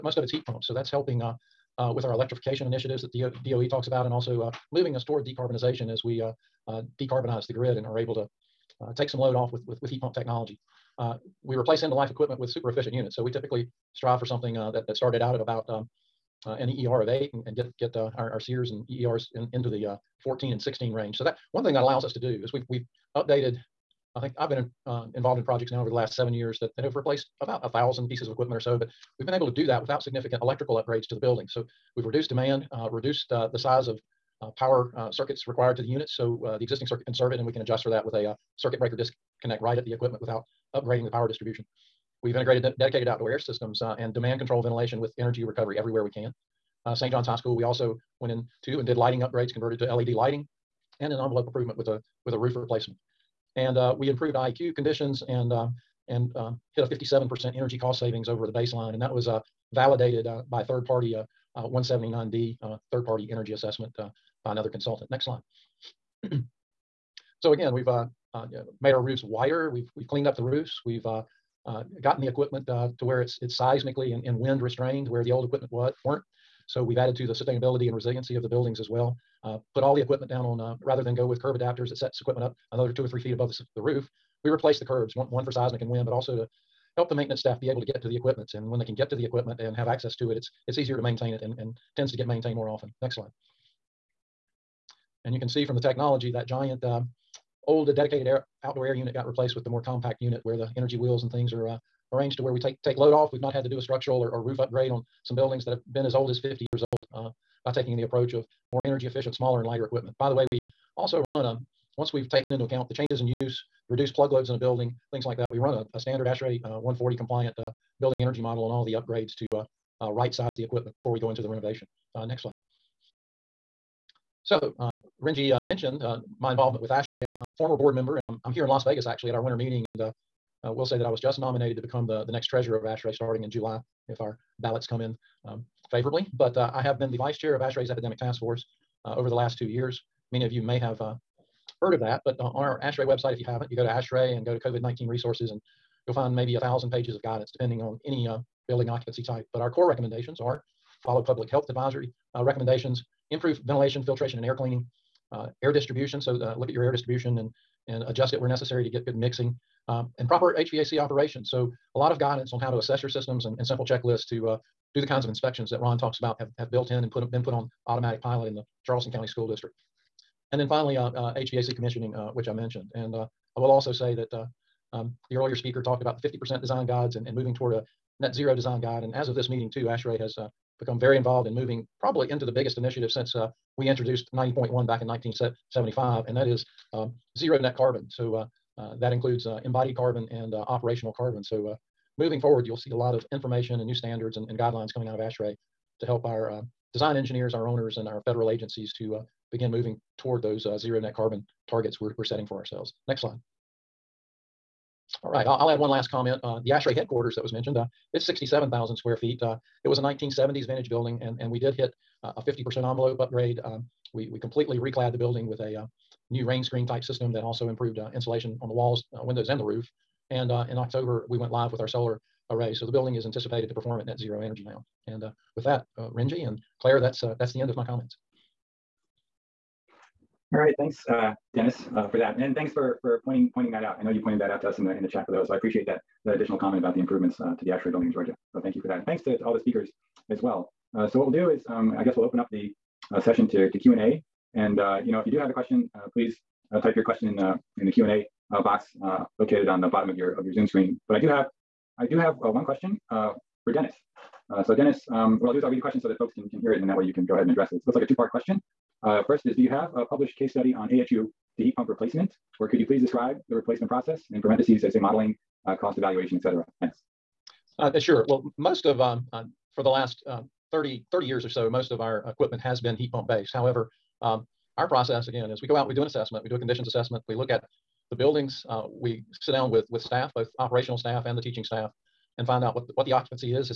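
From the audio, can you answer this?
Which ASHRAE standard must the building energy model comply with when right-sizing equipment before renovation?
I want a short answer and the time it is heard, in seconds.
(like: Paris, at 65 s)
ASHRAE 140, at 116 s.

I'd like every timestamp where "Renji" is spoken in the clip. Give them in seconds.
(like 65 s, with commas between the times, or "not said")
125 s, 226 s.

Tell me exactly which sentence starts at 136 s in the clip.
But uh, I have been the vice chair of ASHRAE's epidemic task force uh, over the last two years.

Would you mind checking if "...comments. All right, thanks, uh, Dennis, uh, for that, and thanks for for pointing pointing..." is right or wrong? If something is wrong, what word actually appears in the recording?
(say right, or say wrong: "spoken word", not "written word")
right.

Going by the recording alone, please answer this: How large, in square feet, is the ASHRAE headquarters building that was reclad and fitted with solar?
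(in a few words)
67,000 square feet.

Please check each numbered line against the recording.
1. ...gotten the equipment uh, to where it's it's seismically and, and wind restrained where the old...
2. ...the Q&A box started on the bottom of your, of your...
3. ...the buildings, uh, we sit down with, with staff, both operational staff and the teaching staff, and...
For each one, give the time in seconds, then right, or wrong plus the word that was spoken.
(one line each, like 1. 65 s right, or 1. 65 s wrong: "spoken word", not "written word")
1. 72 s right
2. 247 s wrong: "located", not "started"
3. 278 s right.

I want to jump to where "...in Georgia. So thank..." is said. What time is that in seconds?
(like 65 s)
238 s.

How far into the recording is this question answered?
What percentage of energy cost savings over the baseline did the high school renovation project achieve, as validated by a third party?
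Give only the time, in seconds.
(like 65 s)
56 s.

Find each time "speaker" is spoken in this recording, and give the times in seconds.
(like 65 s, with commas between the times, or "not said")
175 s, 239 s.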